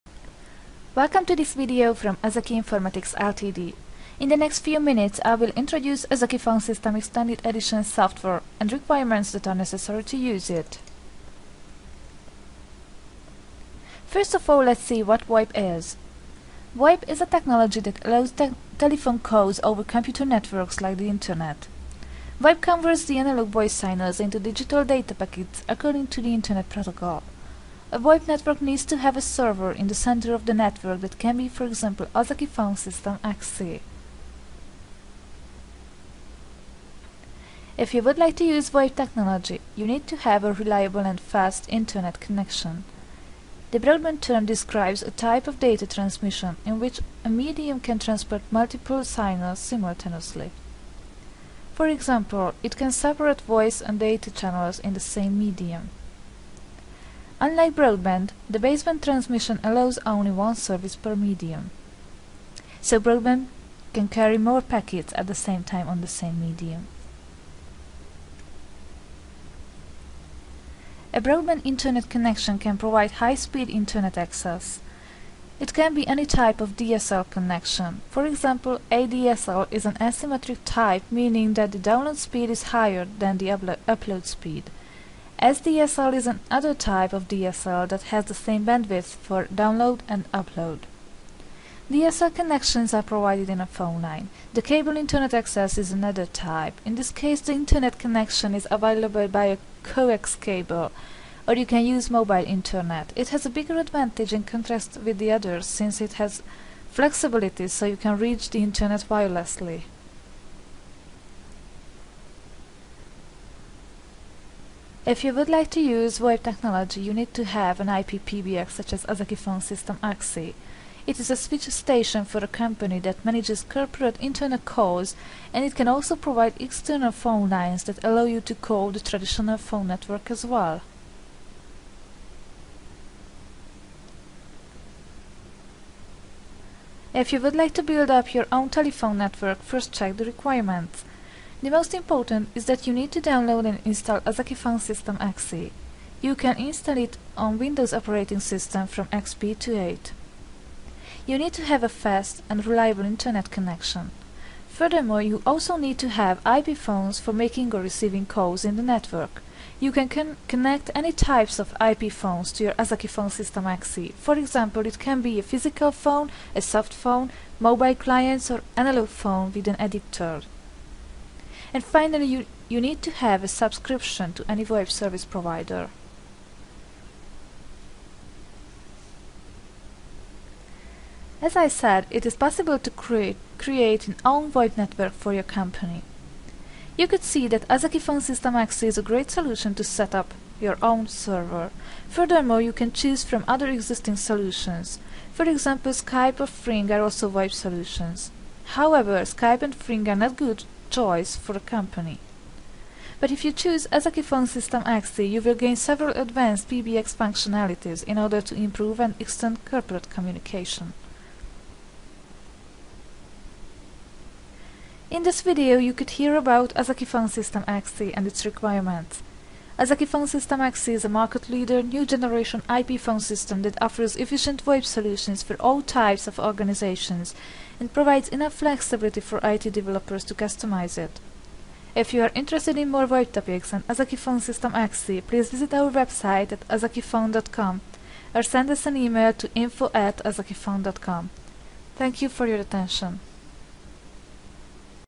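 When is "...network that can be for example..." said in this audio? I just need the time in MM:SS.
00:30.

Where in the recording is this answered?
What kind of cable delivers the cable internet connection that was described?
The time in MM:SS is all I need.
01:39.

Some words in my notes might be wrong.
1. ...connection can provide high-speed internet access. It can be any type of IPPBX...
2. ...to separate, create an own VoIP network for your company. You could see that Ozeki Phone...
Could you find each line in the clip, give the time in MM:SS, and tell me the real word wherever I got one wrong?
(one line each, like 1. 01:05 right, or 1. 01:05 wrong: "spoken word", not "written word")
1. 01:12 wrong: "DSL", not "IPPBX"
2. 03:02 wrong: "create", not "separate".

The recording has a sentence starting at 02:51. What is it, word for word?
And finally, you, you need to have a subscription to any web service provider.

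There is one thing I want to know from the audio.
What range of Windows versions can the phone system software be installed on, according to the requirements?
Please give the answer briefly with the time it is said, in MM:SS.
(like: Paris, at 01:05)
XP to 8, at 02:28.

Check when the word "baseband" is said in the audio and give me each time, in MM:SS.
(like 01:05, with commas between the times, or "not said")
00:58.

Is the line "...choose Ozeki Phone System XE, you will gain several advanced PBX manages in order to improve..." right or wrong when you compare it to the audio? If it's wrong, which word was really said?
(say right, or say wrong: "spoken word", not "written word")
wrong: "functionalities", not "manages".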